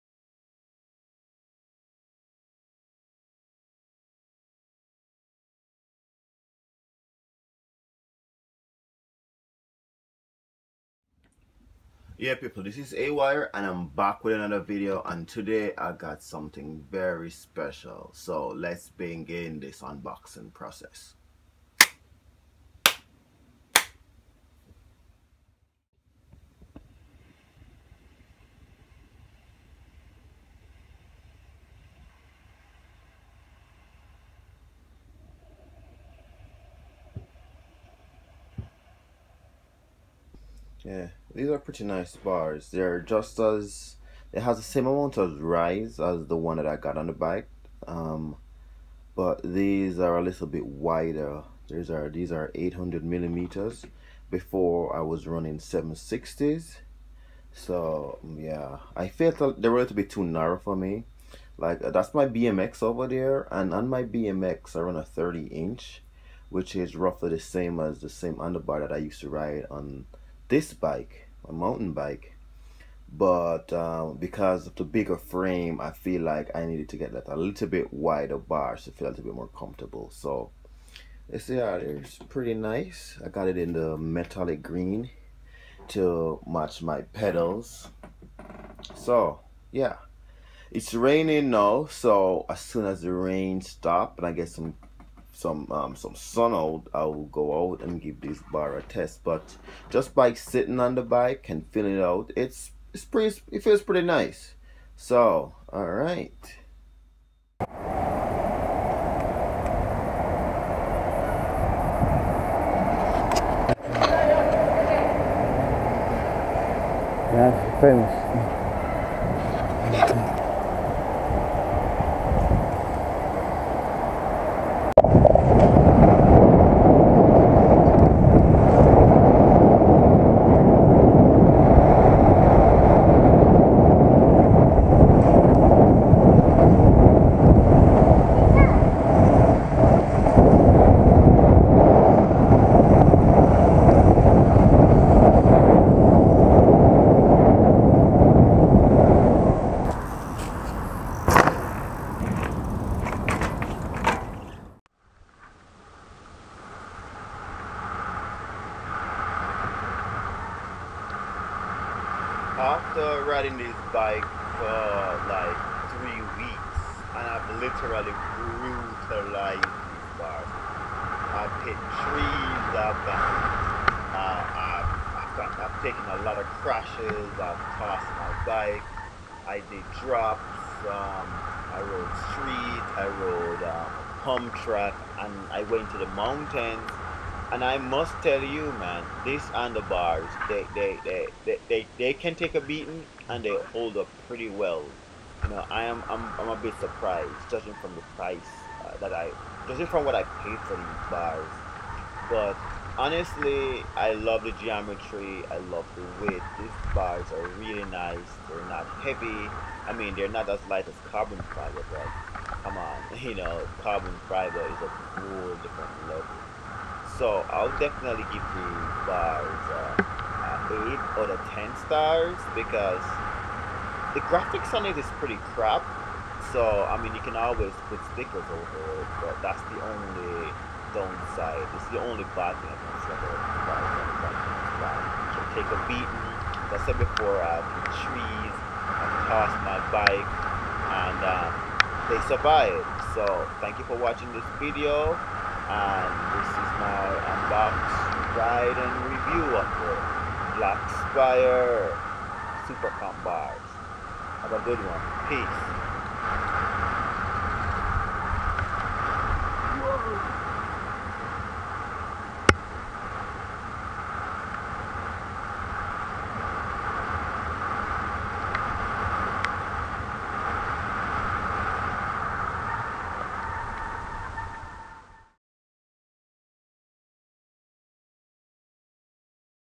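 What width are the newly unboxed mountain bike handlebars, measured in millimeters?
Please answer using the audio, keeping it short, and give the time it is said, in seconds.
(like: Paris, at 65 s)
800 millimeters, at 52 s.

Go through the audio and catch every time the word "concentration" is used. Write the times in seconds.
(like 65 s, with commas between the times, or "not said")
not said.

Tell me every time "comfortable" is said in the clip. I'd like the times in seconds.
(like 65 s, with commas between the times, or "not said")
79 s.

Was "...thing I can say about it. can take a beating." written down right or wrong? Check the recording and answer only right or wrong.
right.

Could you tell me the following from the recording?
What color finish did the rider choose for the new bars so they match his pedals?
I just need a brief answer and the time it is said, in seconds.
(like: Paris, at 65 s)
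metallic green, at 83 s.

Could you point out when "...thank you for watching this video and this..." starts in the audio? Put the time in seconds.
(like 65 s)
243 s.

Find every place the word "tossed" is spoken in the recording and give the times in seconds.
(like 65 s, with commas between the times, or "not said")
177 s, 239 s.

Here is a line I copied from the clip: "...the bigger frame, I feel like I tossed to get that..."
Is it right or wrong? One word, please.
wrong.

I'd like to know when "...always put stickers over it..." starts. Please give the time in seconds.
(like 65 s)
227 s.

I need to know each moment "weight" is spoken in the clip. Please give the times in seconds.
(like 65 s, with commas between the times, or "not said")
206 s.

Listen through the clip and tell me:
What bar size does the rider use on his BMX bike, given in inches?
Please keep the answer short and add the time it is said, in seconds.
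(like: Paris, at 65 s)
30 inch, at 65 s.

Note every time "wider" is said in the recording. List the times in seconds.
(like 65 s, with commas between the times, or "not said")
50 s, 77 s.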